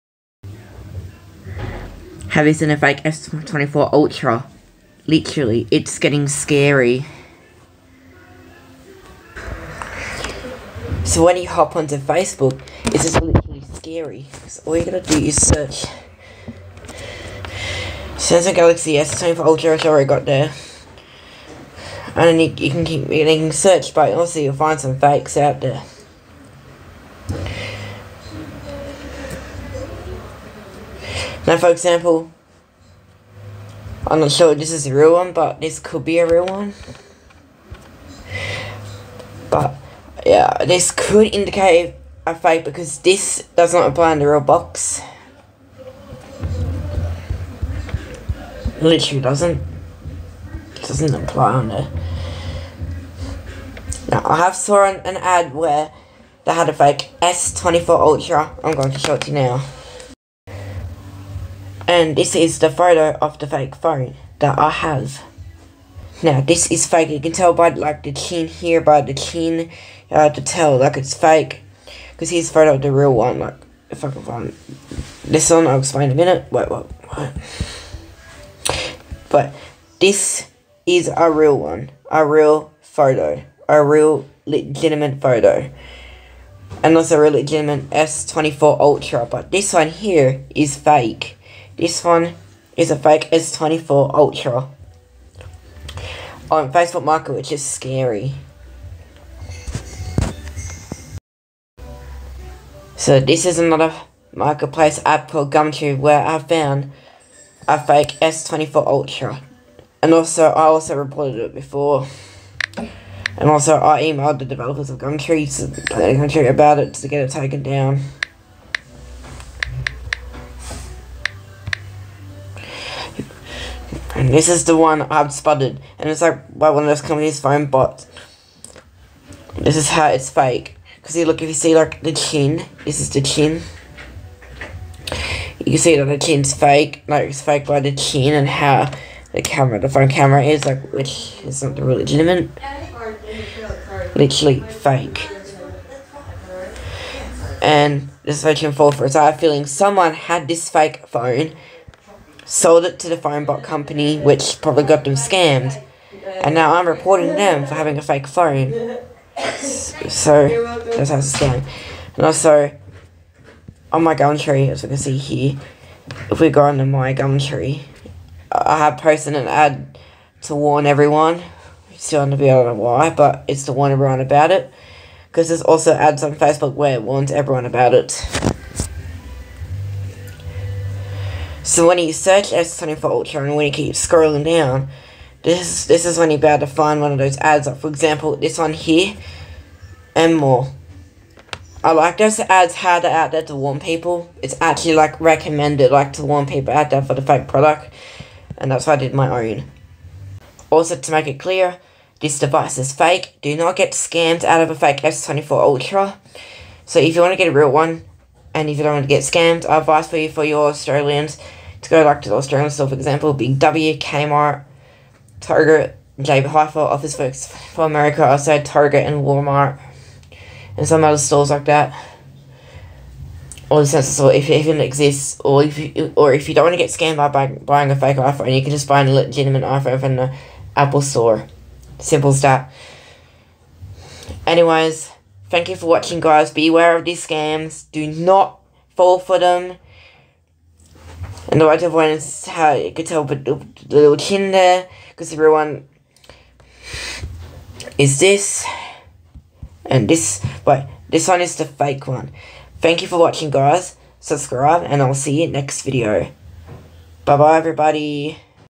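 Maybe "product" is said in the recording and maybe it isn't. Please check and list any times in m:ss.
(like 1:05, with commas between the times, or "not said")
3:17.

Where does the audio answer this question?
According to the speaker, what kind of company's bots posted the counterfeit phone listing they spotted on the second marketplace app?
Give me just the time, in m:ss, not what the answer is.
2:33.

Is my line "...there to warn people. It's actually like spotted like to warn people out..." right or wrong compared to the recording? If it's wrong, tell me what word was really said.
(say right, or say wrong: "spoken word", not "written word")
wrong: "recommended", not "spotted".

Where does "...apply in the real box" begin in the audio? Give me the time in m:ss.
0:43.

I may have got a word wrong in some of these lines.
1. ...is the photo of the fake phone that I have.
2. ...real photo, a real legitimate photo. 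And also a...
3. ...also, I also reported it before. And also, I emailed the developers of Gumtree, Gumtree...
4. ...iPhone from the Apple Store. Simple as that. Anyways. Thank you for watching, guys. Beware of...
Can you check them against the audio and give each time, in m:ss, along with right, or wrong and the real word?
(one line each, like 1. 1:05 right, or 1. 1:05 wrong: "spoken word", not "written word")
1. 1:02 right
2. 1:22 right
3. 1:50 right
4. 3:49 right.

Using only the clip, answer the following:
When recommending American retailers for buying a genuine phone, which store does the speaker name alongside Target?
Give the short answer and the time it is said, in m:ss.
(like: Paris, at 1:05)
Walmart, at 3:39.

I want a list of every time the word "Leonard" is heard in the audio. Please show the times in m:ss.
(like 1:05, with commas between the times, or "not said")
not said.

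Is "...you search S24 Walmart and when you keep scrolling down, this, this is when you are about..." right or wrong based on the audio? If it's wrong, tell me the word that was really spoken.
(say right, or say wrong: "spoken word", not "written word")
wrong: "Ultra", not "Walmart".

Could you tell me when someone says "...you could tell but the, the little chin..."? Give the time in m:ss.
4:02.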